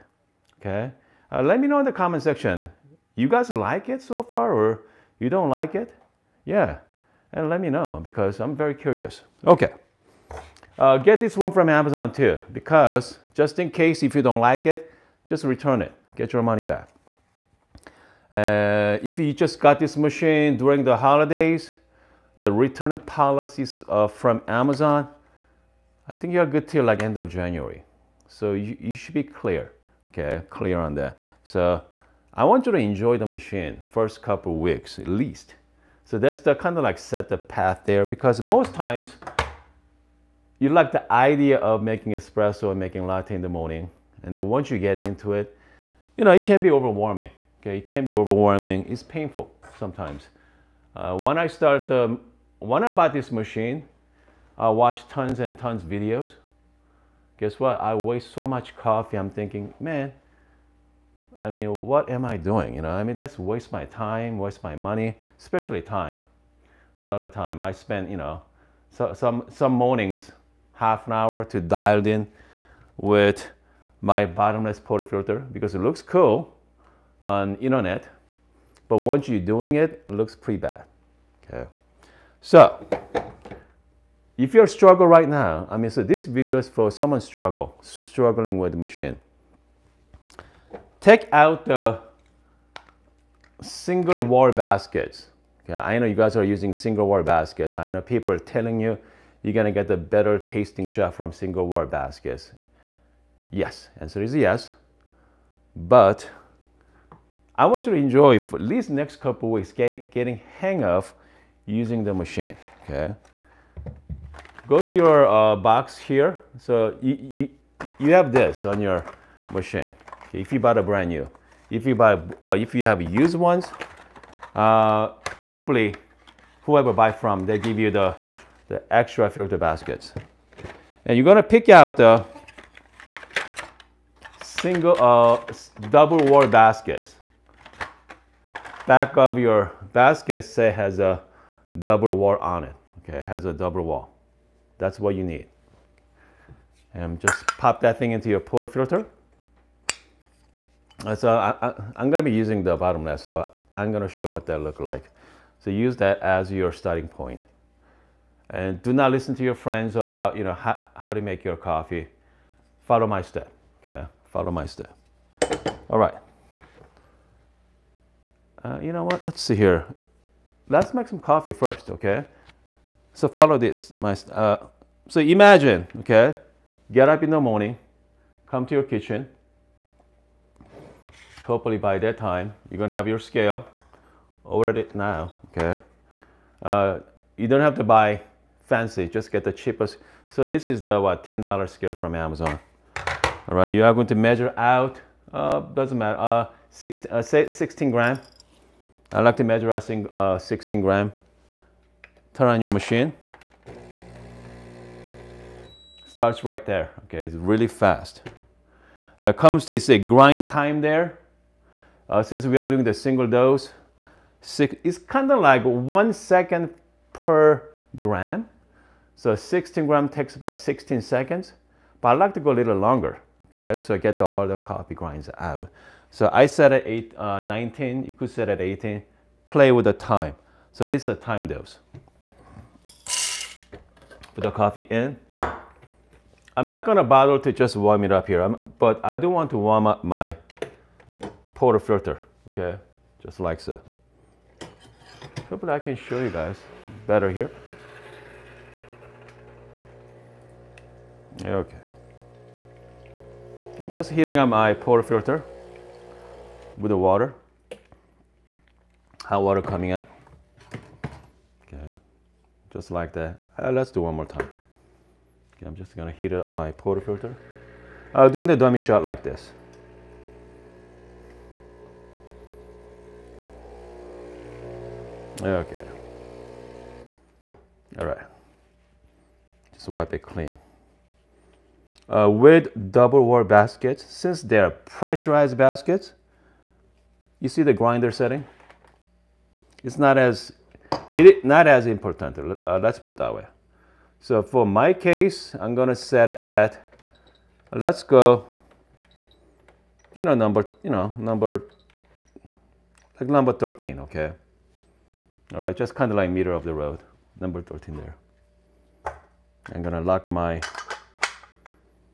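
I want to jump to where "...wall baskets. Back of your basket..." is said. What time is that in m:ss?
2:16.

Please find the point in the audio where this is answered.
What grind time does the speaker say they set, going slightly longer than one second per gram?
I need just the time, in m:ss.
3:47.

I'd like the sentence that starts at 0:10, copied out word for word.
Uh, get this one from Amazon too because just in case if you don't like it, just return it.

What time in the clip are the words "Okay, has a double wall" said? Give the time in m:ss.
2:23.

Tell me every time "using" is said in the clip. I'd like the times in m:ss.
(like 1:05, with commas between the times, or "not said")
1:36, 1:51, 2:32.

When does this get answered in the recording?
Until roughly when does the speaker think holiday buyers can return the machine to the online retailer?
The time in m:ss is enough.
0:27.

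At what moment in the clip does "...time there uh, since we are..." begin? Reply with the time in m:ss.
3:30.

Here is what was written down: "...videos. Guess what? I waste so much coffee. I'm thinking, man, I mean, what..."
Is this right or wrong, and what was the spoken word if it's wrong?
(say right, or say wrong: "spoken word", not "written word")
right.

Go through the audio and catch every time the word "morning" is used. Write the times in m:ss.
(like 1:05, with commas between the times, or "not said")
0:43, 1:09, 2:57.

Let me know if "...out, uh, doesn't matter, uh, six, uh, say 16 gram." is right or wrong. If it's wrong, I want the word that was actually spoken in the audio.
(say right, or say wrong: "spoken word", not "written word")
right.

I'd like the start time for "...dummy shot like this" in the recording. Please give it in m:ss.
4:28.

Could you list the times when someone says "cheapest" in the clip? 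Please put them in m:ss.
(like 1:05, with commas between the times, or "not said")
3:09.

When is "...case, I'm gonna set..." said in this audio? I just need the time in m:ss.
4:54.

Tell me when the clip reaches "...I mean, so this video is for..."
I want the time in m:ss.
1:25.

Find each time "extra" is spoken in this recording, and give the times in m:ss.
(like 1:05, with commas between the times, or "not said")
2:08.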